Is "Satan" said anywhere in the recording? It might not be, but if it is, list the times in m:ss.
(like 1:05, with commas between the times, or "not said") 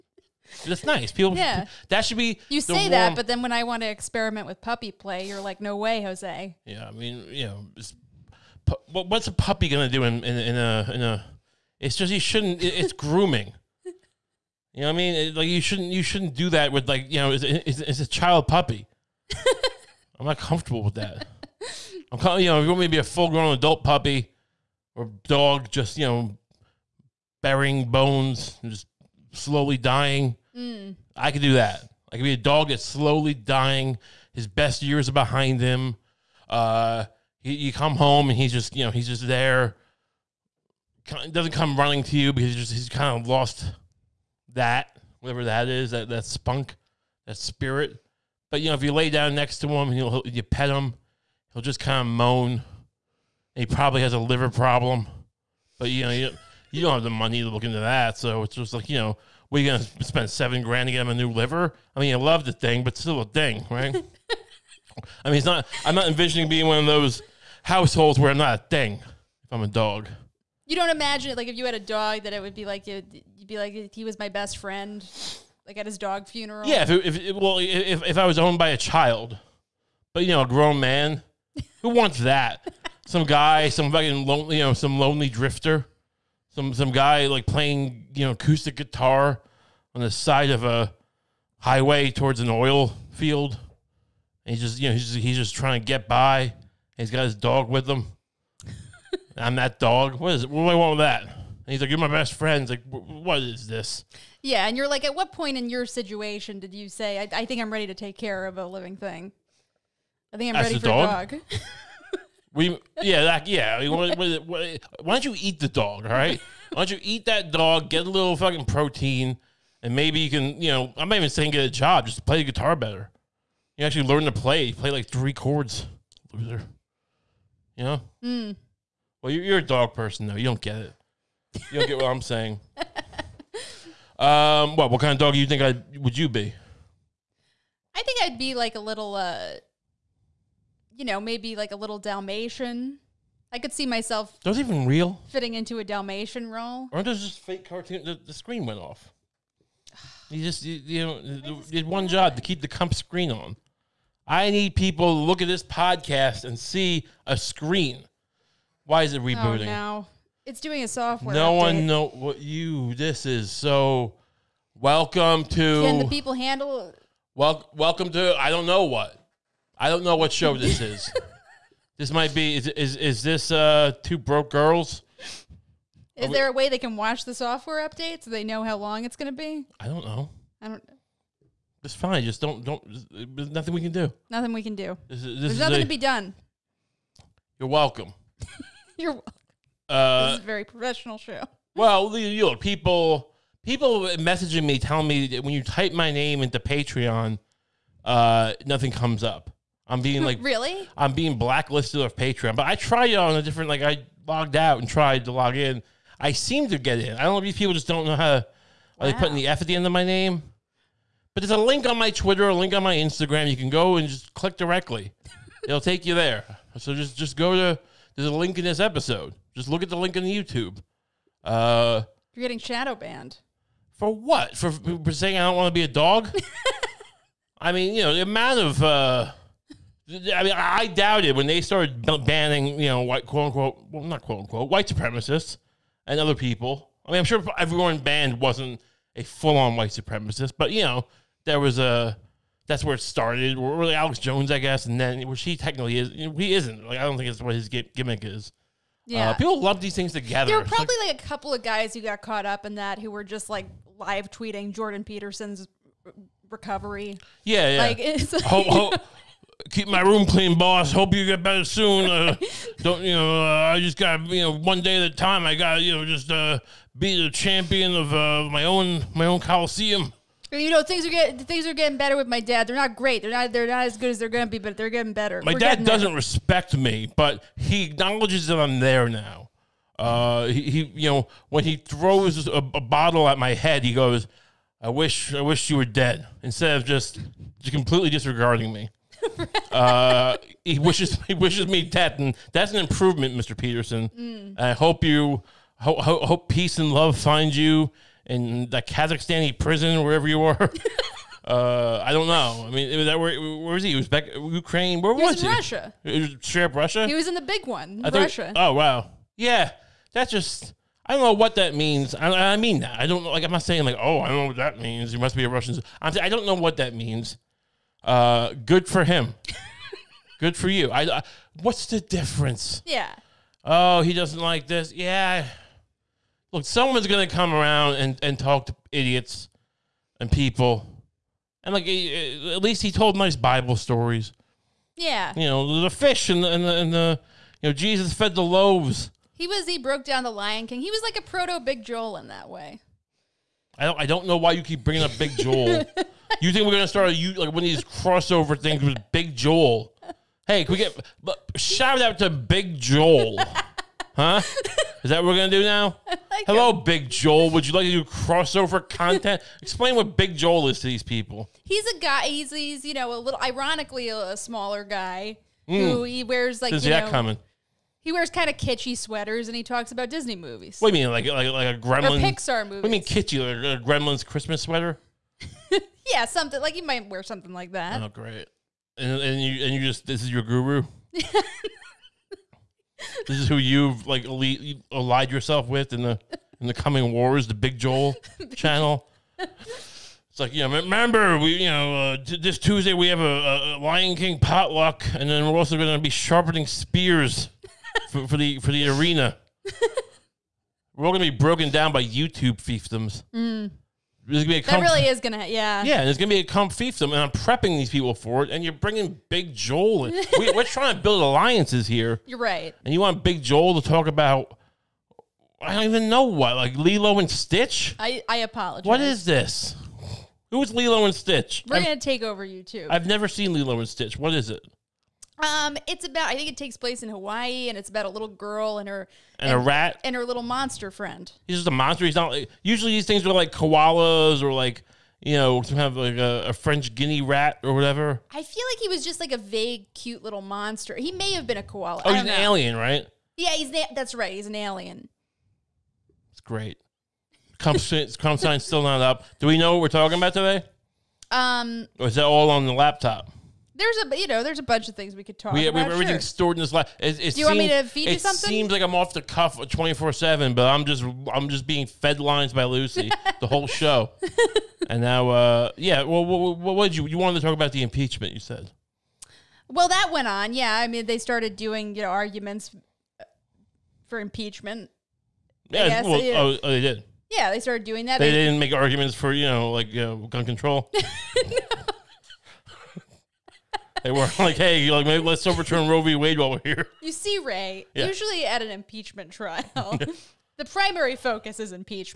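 not said.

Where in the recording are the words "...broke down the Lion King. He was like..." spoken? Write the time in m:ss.
5:39.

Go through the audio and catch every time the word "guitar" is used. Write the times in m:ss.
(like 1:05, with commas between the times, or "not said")
1:28, 2:02.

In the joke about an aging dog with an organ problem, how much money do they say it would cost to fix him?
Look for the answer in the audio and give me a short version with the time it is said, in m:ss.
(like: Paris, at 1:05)
$7,000, at 1:00.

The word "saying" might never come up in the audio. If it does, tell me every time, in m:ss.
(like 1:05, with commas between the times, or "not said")
2:01, 2:12, 3:45, 5:13.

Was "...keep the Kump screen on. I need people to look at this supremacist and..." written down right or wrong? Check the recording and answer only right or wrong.
wrong.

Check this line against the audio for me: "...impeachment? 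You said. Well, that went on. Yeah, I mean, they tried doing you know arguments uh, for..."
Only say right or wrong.
wrong.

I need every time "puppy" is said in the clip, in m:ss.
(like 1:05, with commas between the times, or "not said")
0:04, 0:09, 0:18, 0:23.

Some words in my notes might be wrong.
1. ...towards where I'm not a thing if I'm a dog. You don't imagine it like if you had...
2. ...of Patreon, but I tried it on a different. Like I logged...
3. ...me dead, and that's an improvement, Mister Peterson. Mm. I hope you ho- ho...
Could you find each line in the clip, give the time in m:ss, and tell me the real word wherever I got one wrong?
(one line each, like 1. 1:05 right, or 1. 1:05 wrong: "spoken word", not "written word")
1. 1:07 wrong: "households", not "towards"
2. 3:21 right
3. 4:51 right.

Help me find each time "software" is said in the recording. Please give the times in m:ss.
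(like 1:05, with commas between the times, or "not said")
2:40, 2:57.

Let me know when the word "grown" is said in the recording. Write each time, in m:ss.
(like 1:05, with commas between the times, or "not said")
0:23, 1:20.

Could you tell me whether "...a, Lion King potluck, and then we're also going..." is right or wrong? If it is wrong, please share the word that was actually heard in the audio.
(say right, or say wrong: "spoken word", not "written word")
right.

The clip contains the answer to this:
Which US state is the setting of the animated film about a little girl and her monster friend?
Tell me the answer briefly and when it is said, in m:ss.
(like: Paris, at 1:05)
Hawaii, at 7:07.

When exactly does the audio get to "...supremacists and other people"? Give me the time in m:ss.
3:54.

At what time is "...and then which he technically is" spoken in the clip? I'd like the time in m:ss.
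4:04.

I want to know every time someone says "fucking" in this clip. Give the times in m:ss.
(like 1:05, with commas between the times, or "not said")
1:23, 1:58.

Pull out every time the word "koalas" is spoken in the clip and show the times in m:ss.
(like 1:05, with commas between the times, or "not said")
7:13, 7:21.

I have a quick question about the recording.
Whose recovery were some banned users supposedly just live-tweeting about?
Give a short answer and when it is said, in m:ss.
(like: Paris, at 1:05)
Jordan Peterson, at 4:14.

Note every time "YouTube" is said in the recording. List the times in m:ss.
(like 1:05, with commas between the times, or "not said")
3:40, 6:42, 7:02.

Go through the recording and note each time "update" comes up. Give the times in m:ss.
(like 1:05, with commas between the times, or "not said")
2:41, 2:57.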